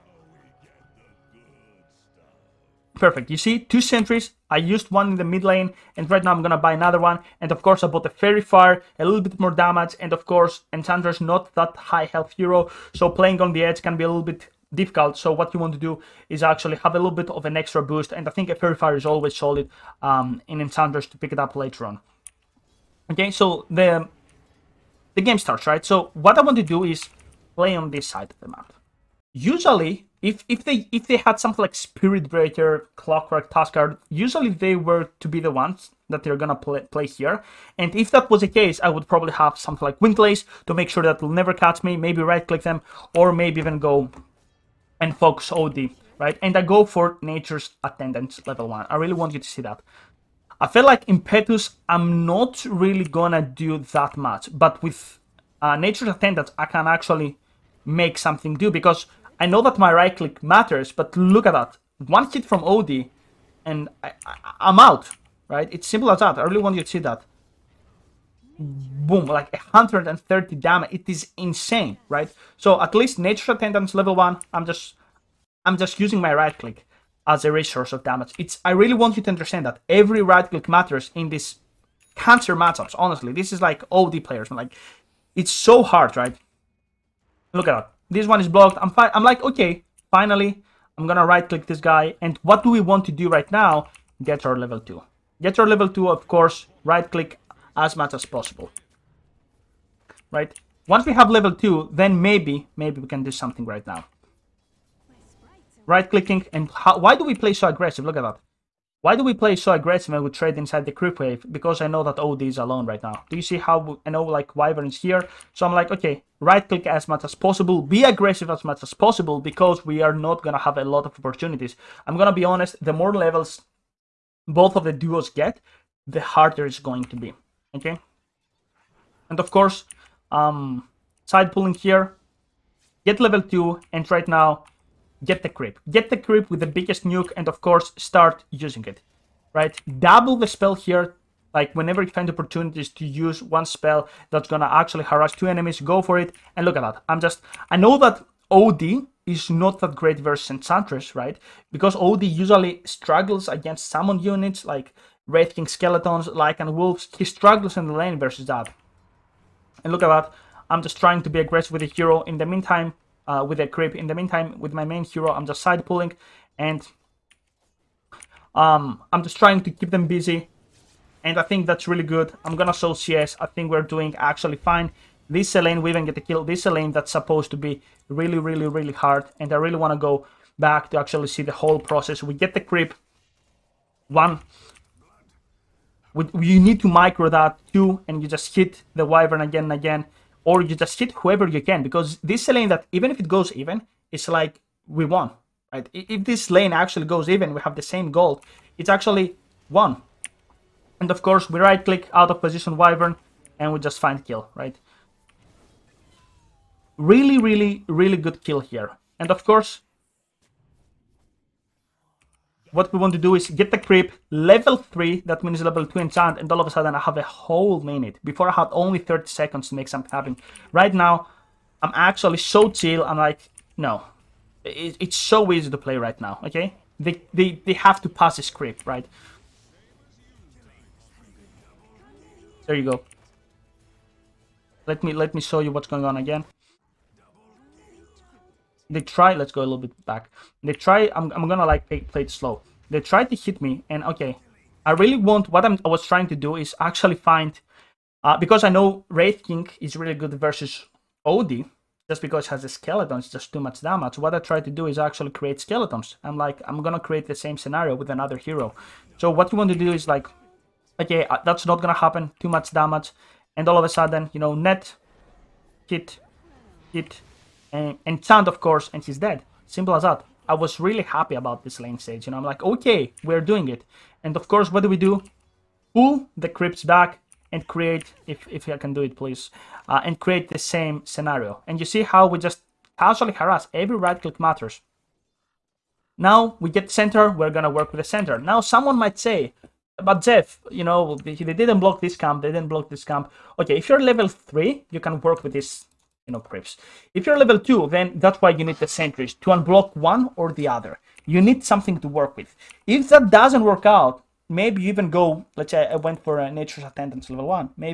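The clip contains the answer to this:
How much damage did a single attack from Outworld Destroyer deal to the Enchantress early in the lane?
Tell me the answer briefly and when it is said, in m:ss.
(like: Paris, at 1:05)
130, at 1:09.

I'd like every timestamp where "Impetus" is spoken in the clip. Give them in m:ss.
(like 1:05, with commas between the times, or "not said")
0:51.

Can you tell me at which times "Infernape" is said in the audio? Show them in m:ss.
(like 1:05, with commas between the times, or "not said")
not said.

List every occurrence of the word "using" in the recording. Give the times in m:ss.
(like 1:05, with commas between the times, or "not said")
1:15, 2:18.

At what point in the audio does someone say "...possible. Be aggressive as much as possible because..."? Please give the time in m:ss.
1:57.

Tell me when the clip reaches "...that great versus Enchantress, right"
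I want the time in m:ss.
2:29.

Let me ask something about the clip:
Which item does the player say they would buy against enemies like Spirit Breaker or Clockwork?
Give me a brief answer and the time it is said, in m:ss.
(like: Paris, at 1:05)
Windlace, at 0:39.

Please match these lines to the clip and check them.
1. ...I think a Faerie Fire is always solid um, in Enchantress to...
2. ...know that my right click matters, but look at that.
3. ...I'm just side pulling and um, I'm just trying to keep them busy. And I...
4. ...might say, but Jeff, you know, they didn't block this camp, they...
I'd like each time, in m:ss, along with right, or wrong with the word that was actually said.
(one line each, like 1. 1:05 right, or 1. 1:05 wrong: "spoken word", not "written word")
1. 0:18 right
2. 0:59 right
3. 2:45 right
4. 4:48 right.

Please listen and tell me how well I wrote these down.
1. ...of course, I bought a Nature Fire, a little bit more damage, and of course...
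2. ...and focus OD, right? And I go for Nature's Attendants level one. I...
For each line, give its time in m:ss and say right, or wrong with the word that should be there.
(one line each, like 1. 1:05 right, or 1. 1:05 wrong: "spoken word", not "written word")
1. 0:07 wrong: "Faerie", not "Nature"
2. 0:44 right.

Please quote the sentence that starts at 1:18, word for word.
It's I really want you to understand that every right click matters in this cancer matchups, honestly.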